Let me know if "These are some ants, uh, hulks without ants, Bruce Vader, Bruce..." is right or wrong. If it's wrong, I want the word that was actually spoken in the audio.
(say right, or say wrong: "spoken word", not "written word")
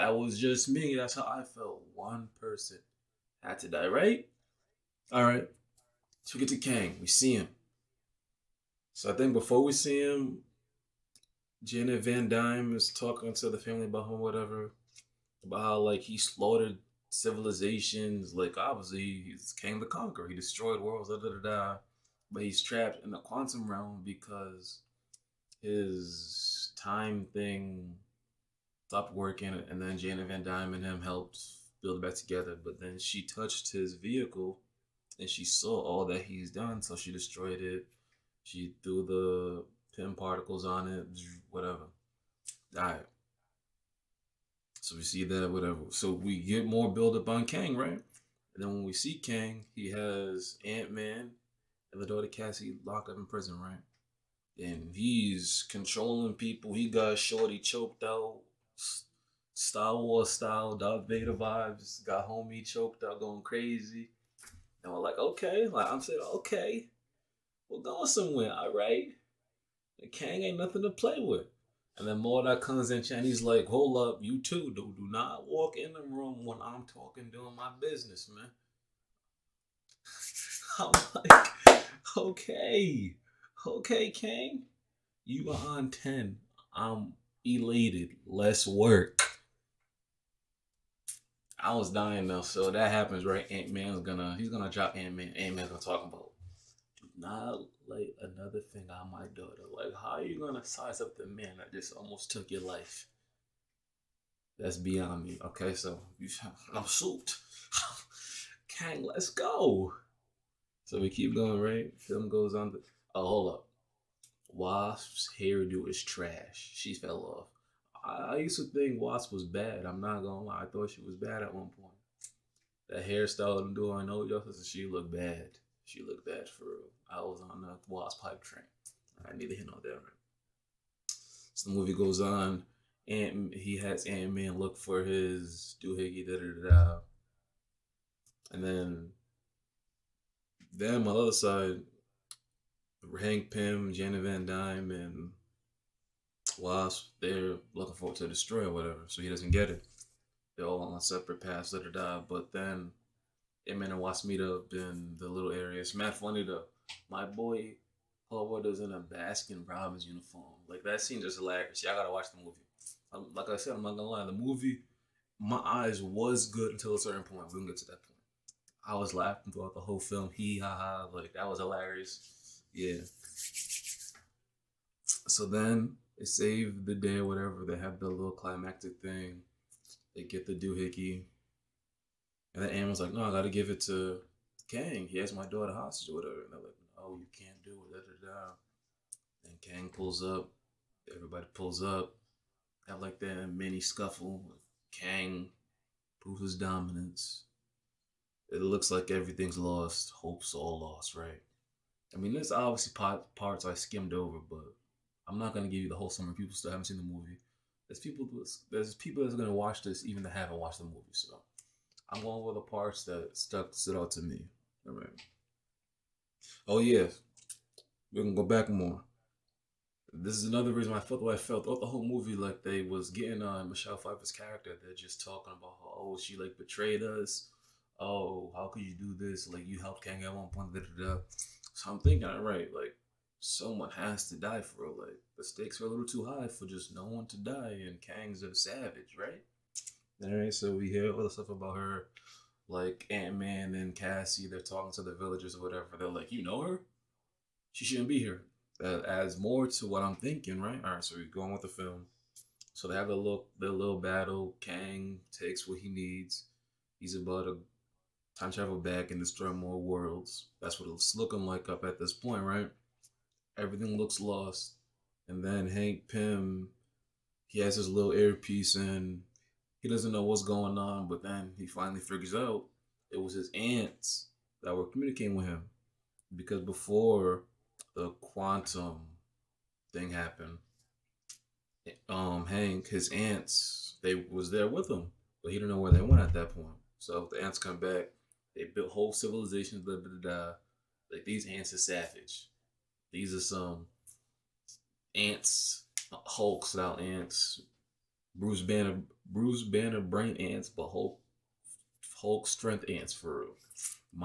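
wrong: "Banner", not "Vader".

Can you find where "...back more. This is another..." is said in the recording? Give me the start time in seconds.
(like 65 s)
218 s.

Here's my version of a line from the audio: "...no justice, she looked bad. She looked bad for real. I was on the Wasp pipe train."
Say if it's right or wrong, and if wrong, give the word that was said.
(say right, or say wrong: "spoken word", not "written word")
right.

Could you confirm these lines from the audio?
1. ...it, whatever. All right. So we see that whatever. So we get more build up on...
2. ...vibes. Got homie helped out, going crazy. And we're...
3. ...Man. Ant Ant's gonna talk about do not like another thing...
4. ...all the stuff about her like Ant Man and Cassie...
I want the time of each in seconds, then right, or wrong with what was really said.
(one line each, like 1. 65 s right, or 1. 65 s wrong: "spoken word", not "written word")
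1. 40 s right
2. 61 s wrong: "choked", not "helped"
3. 95 s wrong: "Man", not "Ant"
4. 241 s right.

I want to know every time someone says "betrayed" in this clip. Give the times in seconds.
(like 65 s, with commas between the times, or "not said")
226 s.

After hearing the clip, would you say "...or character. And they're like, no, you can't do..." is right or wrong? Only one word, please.
wrong.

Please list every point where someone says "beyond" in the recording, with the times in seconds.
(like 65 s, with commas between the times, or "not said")
104 s.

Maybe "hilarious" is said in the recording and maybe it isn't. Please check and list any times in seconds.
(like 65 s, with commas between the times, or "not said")
161 s, 171 s.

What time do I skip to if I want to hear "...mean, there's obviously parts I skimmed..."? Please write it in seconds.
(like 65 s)
202 s.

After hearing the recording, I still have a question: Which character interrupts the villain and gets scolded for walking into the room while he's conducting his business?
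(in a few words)
Mordai.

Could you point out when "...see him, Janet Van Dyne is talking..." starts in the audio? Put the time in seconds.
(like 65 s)
9 s.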